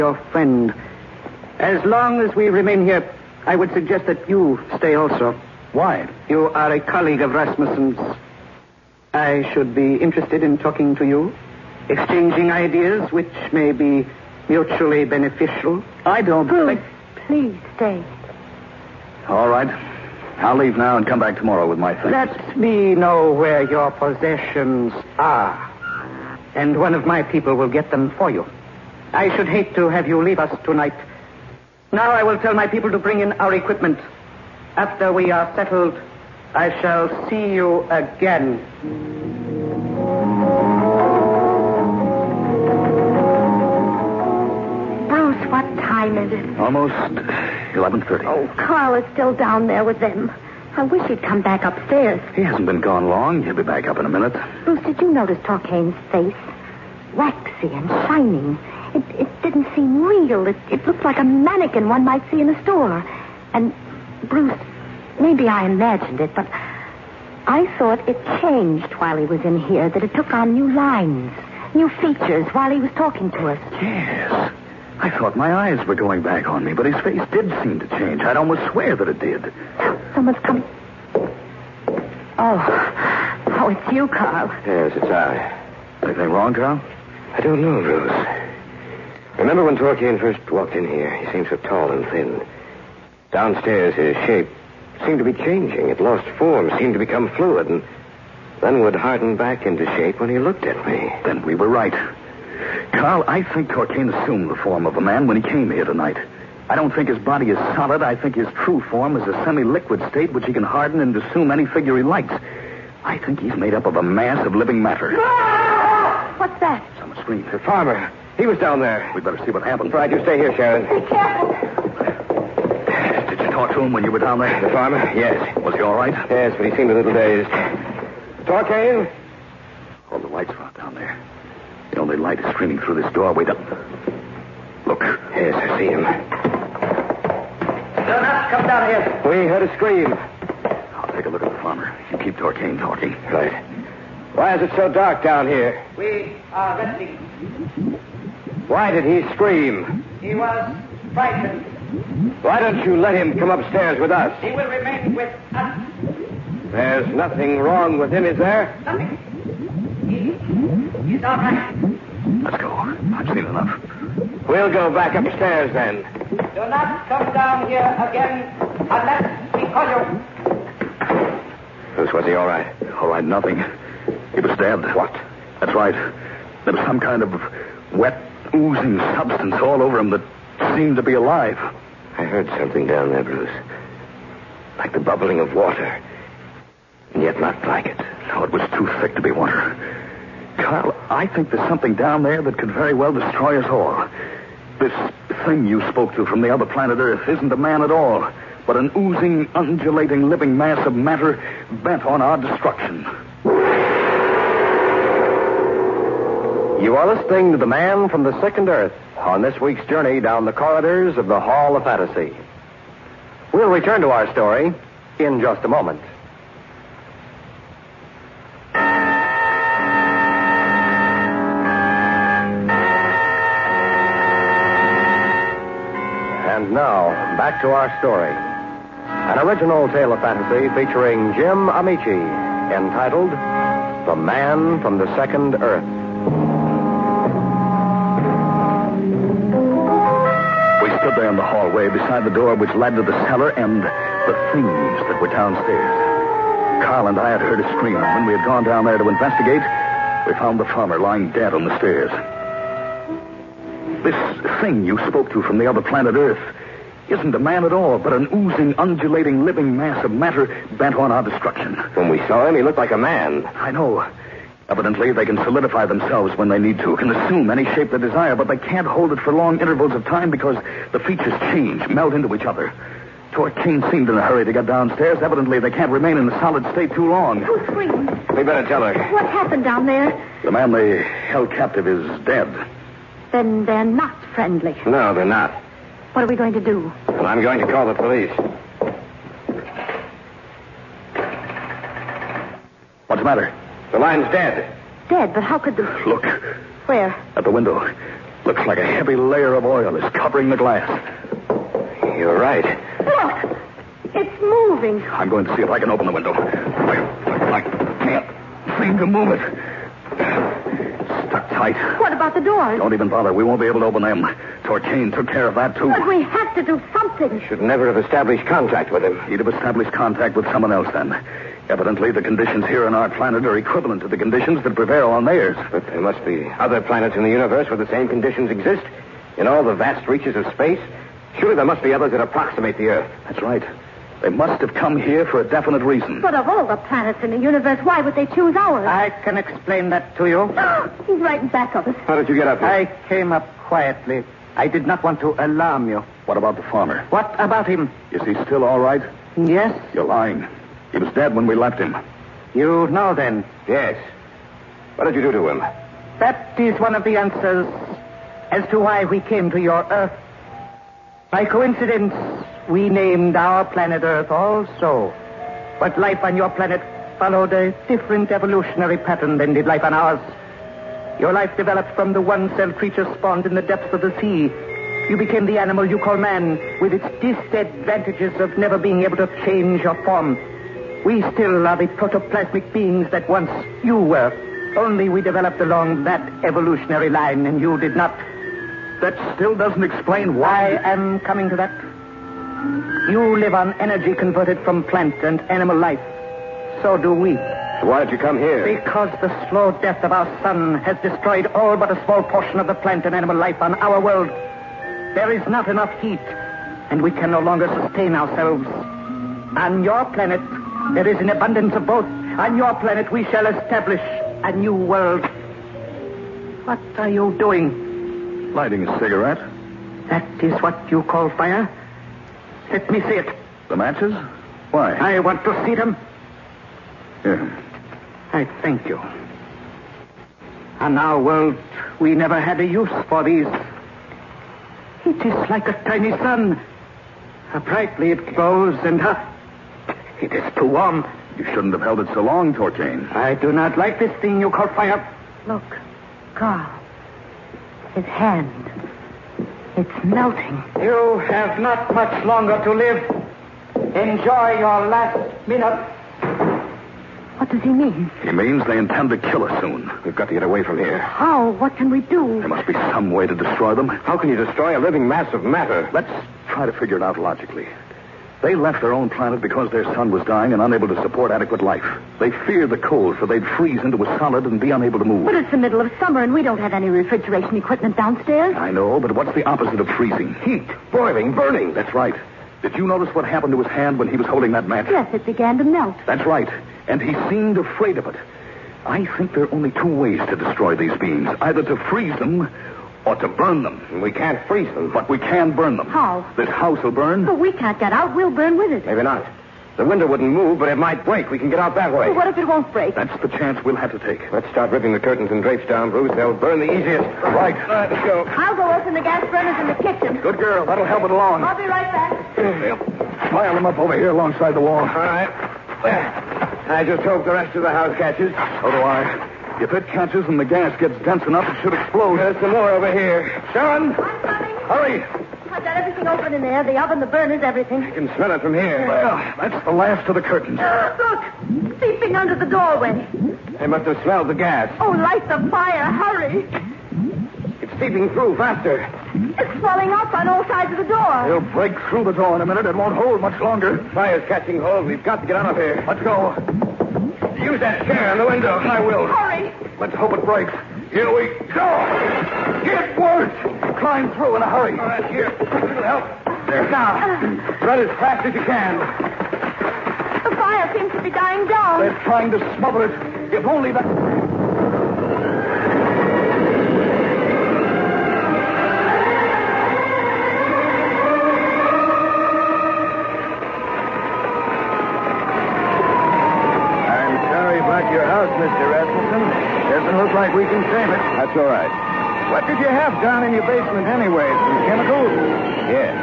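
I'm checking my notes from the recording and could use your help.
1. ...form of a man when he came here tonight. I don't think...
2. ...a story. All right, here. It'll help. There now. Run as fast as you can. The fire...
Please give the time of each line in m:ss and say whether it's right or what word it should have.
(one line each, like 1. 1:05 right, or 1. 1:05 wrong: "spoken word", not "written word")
1. 1:44 right
2. 9:14 wrong: "hurry", not "story".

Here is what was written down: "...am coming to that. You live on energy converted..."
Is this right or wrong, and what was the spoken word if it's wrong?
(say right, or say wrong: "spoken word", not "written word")
right.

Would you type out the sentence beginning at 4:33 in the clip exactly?
Torquane seemed in a hurry to get downstairs.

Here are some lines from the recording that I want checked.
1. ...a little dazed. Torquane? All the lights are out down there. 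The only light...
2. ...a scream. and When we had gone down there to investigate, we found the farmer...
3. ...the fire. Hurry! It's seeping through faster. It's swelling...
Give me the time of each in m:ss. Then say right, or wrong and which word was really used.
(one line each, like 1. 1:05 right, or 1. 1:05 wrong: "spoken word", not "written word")
1. 2:06 right
2. 4:07 right
3. 8:55 right.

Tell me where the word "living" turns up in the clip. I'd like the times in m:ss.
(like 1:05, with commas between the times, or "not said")
1:54, 3:20, 4:19, 7:44.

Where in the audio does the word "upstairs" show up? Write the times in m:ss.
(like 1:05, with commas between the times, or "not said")
0:51, 2:33, 2:45.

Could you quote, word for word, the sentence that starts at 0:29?
I should hate to have you leave us tonight.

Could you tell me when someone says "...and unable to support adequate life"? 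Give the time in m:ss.
7:50.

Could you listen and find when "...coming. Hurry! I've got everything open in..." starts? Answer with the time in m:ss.
8:43.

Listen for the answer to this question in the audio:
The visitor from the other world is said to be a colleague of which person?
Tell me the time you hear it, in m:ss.
0:07.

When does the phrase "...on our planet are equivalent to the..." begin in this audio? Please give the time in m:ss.
5:22.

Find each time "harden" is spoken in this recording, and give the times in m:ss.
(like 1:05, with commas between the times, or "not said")
1:38, 1:50.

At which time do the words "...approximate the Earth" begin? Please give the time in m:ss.
5:32.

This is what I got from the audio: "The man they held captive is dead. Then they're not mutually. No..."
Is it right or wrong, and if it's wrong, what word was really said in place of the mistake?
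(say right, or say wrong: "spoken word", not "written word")
wrong: "friendly", not "mutually".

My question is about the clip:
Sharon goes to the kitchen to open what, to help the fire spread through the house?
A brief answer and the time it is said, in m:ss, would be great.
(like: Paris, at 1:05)
The gas burners, at 8:29.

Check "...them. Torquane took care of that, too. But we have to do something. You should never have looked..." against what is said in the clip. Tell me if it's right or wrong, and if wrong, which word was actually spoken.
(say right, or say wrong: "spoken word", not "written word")
wrong: "established", not "looked".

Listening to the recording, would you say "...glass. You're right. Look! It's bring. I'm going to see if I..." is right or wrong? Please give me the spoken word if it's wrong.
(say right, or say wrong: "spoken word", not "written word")
wrong: "moving", not "bring".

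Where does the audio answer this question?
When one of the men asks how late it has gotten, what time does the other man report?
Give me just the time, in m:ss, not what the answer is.
0:46.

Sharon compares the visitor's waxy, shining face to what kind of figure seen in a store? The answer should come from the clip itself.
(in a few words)
A mannequin.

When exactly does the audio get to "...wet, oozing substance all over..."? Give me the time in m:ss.
2:57.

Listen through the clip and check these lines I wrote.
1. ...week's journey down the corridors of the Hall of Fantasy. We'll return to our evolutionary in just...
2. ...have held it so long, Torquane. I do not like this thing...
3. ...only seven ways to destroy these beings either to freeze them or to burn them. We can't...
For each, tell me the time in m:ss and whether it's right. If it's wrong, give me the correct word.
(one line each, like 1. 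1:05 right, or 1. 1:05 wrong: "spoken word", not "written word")
1. 3:29 wrong: "story", not "evolutionary"
2. 7:21 right
3. 8:09 wrong: "two", not "seven".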